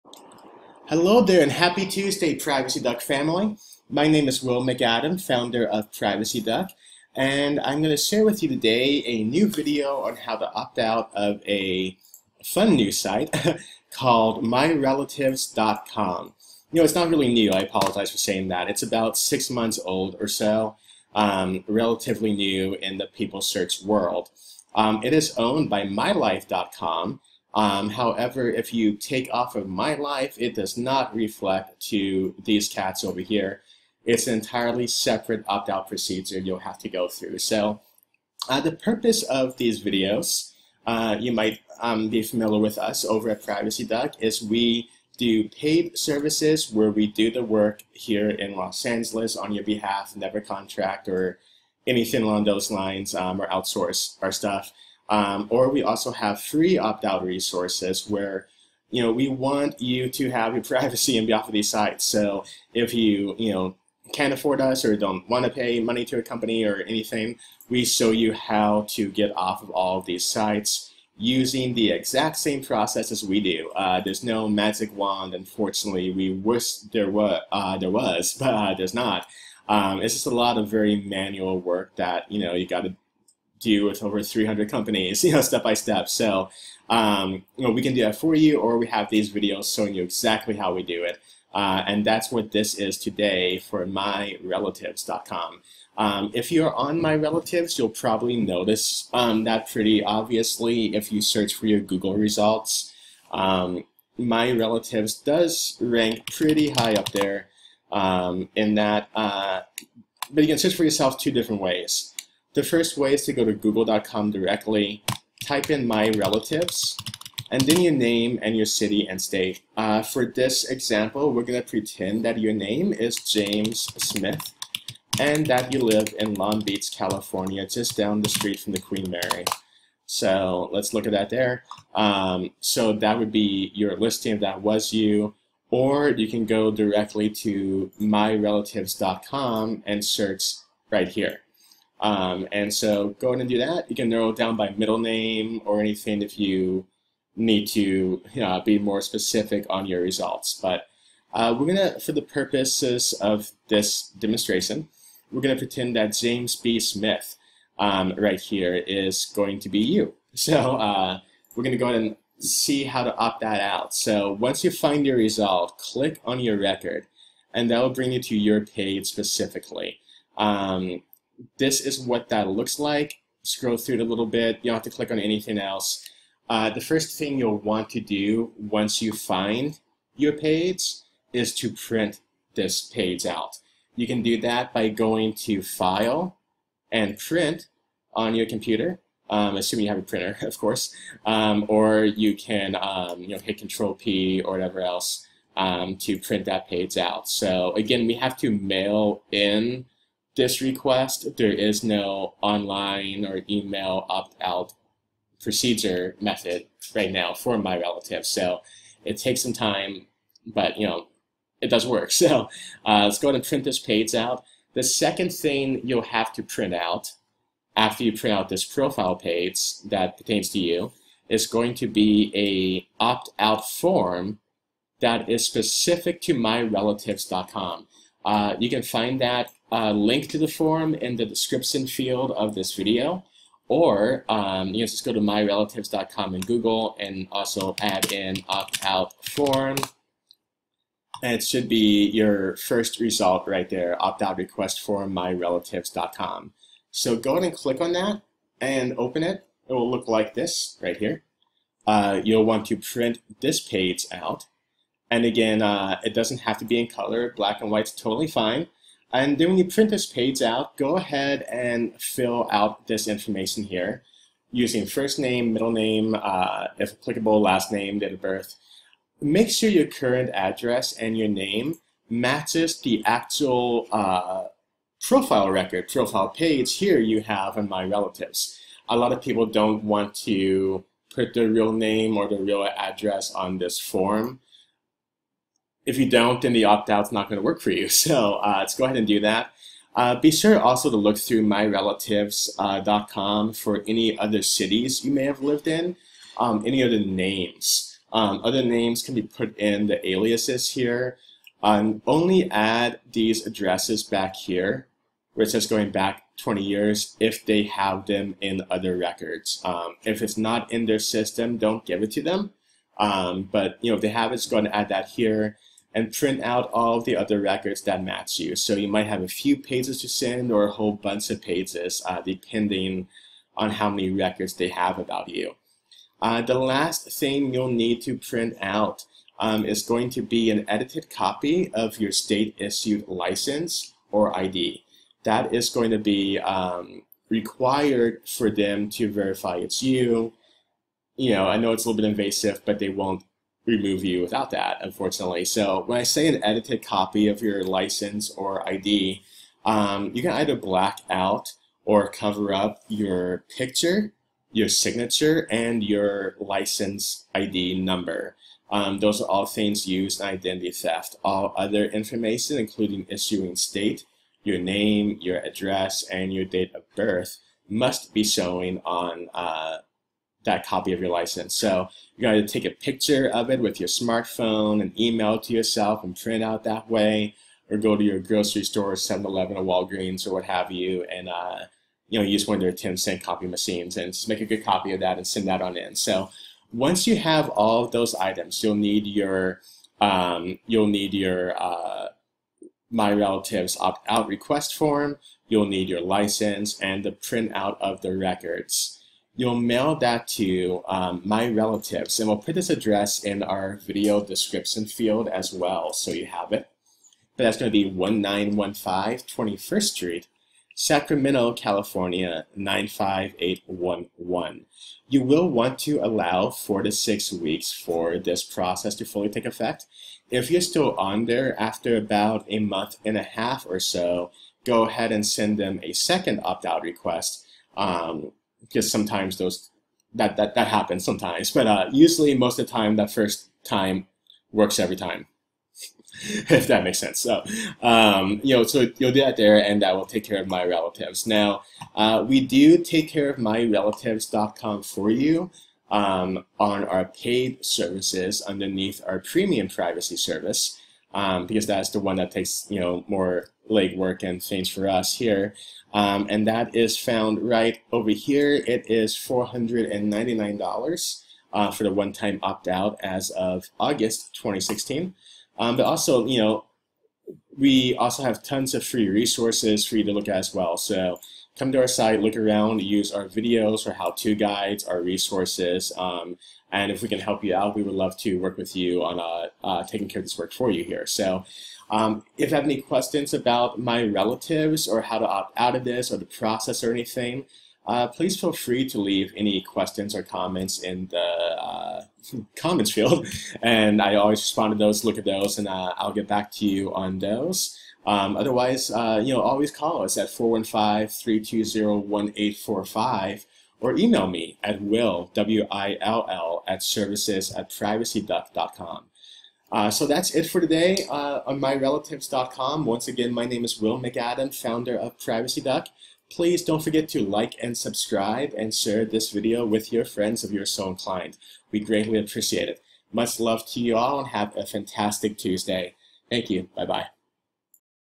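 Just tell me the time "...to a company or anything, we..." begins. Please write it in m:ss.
1:06.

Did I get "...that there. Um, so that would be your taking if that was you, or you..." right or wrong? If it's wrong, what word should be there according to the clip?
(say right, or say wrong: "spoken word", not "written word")
wrong: "listing", not "taking".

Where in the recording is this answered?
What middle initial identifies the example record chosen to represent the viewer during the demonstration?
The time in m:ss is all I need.
2:36.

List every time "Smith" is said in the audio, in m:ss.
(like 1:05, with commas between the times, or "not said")
2:04, 2:36.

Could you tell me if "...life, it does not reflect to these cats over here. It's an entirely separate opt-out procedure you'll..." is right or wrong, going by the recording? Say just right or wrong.
right.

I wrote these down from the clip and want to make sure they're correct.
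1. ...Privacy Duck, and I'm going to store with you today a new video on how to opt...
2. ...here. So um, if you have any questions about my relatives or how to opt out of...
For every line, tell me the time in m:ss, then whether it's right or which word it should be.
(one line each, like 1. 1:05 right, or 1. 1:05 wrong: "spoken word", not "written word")
1. 0:05 wrong: "share", not "store"
2. 8:00 right.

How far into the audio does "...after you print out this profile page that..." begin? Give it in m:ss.
3:37.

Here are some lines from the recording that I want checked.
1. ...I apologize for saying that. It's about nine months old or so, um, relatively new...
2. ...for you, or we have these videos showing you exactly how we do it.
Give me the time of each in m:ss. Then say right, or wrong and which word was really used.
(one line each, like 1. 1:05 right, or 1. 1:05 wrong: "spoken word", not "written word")
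1. 0:17 wrong: "six", not "nine"
2. 1:28 right.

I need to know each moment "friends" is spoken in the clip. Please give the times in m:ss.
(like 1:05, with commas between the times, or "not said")
8:40.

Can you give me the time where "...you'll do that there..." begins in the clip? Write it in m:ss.
7:18.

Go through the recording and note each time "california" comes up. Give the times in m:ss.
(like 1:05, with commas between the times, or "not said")
2:06, 6:51.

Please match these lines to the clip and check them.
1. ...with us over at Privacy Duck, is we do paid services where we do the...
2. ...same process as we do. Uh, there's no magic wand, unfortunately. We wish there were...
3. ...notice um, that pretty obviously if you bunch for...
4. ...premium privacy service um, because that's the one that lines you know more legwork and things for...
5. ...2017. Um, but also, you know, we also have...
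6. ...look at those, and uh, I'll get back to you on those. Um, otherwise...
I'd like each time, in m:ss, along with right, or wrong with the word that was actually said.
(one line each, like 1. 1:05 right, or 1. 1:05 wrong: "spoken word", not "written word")
1. 0:42 right
2. 1:12 right
3. 1:38 wrong: "search", not "bunch"
4. 7:29 wrong: "takes", not "lines"
5. 7:44 wrong: "2016", not "2017"
6. 8:15 right.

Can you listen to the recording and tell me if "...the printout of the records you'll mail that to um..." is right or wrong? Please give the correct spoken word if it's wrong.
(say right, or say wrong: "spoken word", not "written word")
right.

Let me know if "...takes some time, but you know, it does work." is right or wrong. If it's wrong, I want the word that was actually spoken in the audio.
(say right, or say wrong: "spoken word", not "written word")
right.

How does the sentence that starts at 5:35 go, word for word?
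That is going to be um, required for them to verify it's you.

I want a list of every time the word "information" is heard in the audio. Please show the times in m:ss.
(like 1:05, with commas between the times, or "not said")
4:23, 6:01.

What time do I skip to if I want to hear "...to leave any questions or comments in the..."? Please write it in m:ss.
8:08.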